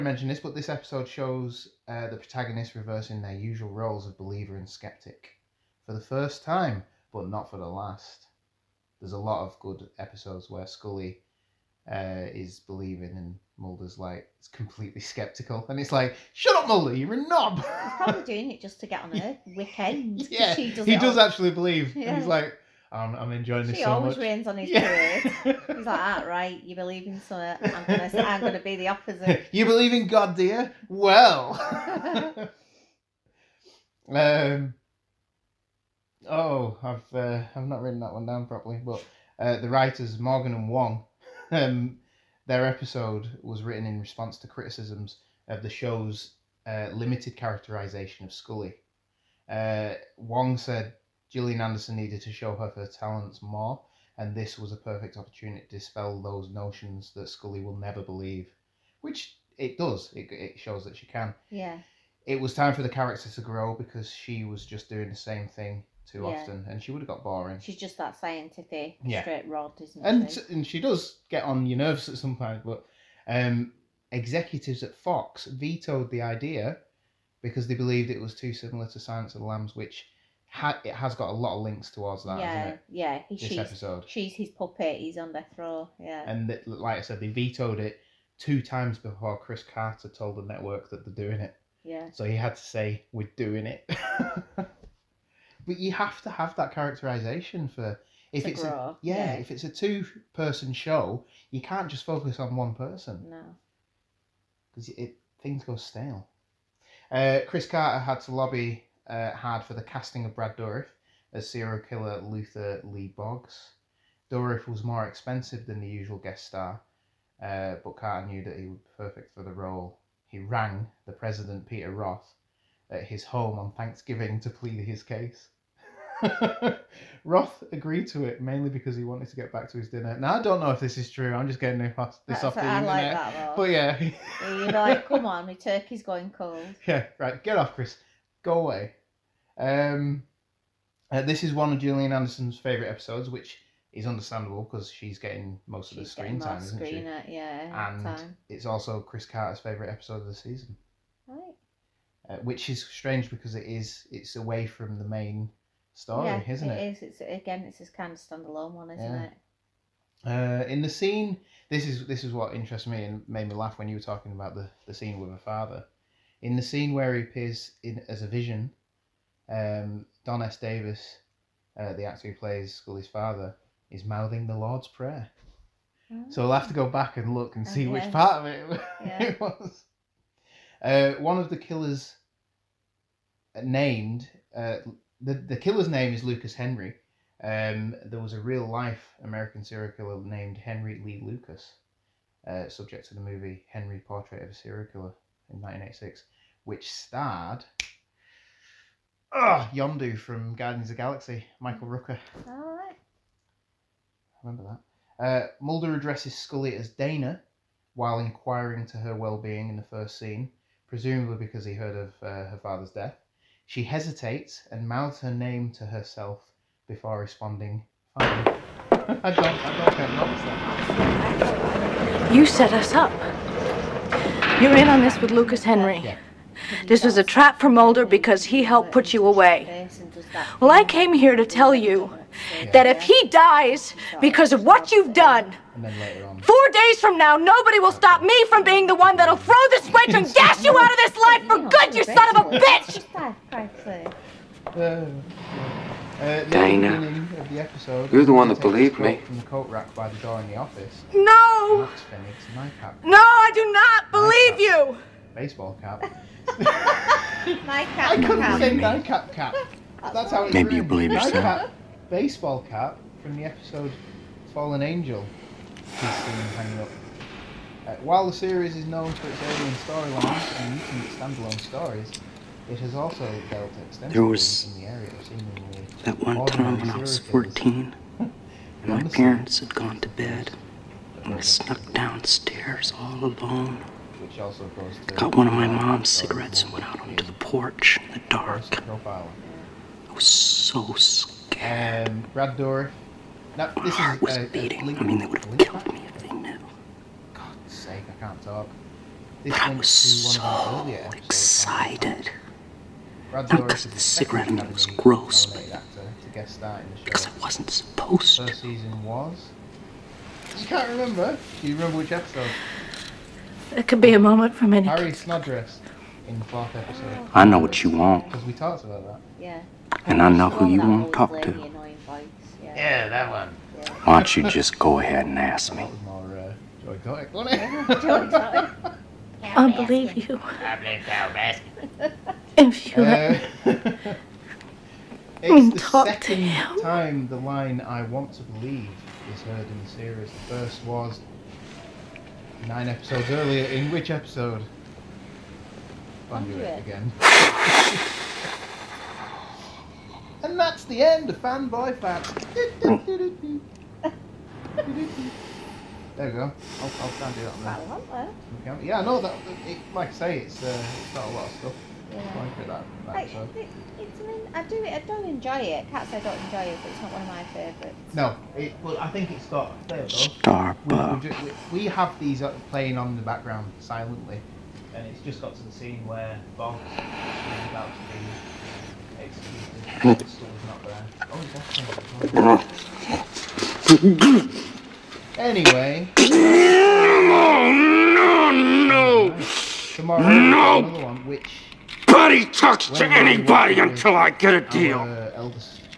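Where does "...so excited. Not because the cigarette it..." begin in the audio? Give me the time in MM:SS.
04:59.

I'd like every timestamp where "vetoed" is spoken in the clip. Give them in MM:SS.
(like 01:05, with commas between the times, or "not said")
01:15, 01:27.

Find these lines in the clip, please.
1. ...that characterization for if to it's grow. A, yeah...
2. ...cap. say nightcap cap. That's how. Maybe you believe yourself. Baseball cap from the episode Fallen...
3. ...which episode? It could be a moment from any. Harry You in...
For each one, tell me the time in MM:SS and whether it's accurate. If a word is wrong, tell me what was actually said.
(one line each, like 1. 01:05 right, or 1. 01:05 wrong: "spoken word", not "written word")
1. 01:36 right
2. 04:18 right
3. 05:11 wrong: "Snodgrass", not "You".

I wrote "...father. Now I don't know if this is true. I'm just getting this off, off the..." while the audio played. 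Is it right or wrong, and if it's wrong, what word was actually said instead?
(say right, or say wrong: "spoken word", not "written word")
wrong: "dinner", not "father".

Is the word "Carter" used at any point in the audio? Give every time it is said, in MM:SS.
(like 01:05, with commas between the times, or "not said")
01:29, 01:47, 01:57, 02:29.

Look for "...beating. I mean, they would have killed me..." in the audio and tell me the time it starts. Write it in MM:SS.
04:54.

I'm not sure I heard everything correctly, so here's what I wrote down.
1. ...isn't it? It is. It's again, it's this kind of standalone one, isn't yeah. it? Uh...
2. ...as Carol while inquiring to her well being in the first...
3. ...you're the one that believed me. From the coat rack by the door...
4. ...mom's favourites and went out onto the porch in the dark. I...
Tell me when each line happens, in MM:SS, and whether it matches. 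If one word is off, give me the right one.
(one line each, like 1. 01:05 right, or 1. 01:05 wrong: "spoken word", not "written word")
1. 02:36 right
2. 03:26 wrong: "Dana", not "Carol"
3. 04:08 right
4. 04:45 wrong: "cigarettes", not "favourites".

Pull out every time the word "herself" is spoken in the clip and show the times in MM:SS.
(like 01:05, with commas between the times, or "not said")
03:35.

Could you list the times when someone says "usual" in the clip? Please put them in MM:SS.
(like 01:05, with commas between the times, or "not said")
00:03, 01:55.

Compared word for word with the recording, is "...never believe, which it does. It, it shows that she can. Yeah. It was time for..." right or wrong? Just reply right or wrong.
right.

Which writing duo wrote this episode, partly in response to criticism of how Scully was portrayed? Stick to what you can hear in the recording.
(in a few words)
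Morgan and Wong.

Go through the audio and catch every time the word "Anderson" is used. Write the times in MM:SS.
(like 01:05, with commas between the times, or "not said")
00:51, 02:22.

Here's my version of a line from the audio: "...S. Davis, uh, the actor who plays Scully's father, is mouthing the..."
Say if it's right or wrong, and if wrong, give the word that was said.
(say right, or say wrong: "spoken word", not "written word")
right.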